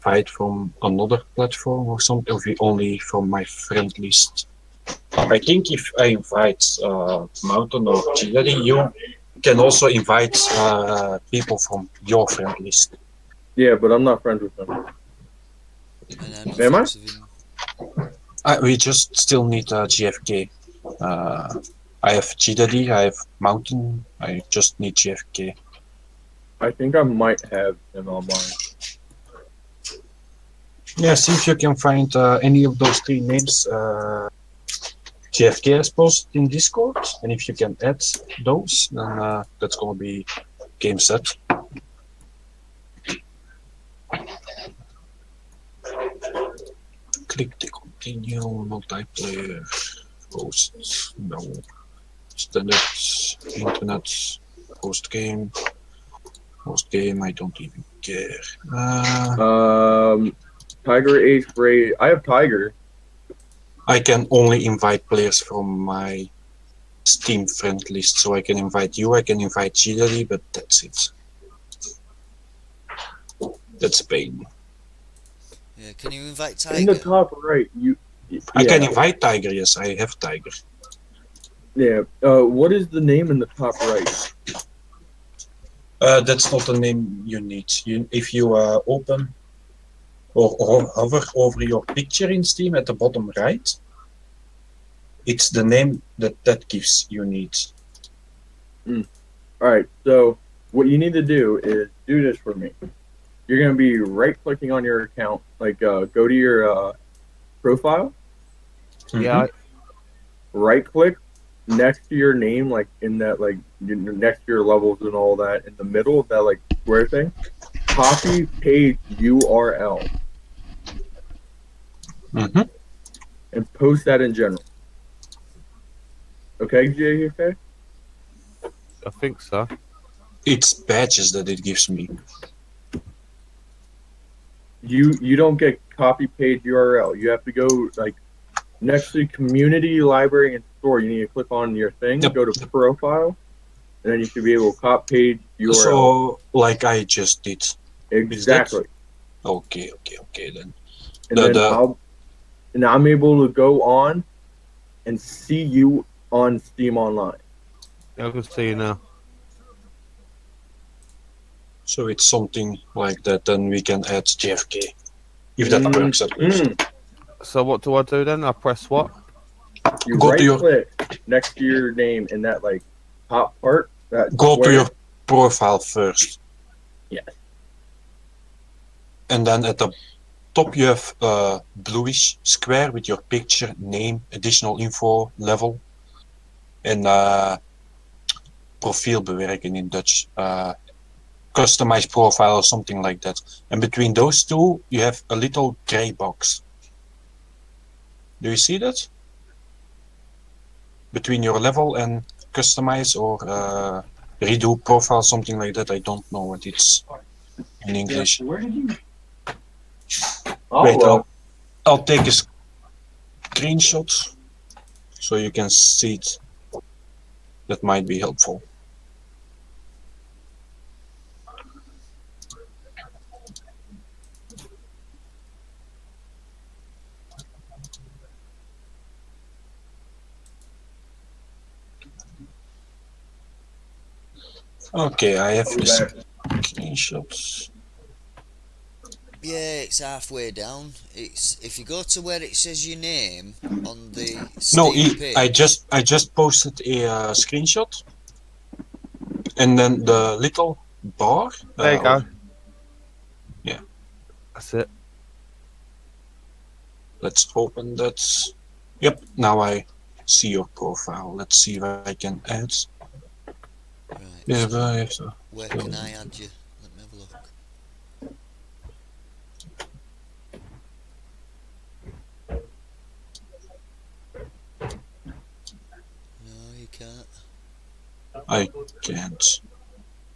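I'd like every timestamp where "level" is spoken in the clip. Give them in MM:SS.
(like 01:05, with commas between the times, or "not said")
01:54, 03:05, 03:21.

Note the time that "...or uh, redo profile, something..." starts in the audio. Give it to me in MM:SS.
03:23.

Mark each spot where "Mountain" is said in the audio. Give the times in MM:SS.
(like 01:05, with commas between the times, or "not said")
00:07, 00:23.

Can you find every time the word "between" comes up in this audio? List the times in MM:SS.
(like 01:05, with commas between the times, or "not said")
03:13, 03:21.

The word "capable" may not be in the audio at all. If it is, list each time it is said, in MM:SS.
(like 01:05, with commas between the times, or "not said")
not said.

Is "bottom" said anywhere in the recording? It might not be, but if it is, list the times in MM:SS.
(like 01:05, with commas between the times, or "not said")
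01:32.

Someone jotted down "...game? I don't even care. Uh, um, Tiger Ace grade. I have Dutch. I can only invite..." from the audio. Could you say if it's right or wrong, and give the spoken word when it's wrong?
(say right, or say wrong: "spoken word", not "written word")
wrong: "Tiger", not "Dutch".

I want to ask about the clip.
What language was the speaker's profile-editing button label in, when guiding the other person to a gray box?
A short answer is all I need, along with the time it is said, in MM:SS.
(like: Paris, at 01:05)
Dutch, at 03:09.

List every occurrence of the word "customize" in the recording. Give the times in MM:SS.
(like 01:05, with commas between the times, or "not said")
03:11, 03:22.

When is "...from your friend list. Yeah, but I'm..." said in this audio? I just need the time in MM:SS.
00:11.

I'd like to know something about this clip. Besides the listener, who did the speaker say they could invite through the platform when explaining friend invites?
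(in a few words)
Chidori.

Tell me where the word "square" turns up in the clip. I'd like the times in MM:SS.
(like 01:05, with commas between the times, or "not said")
01:56, 02:54, 03:02.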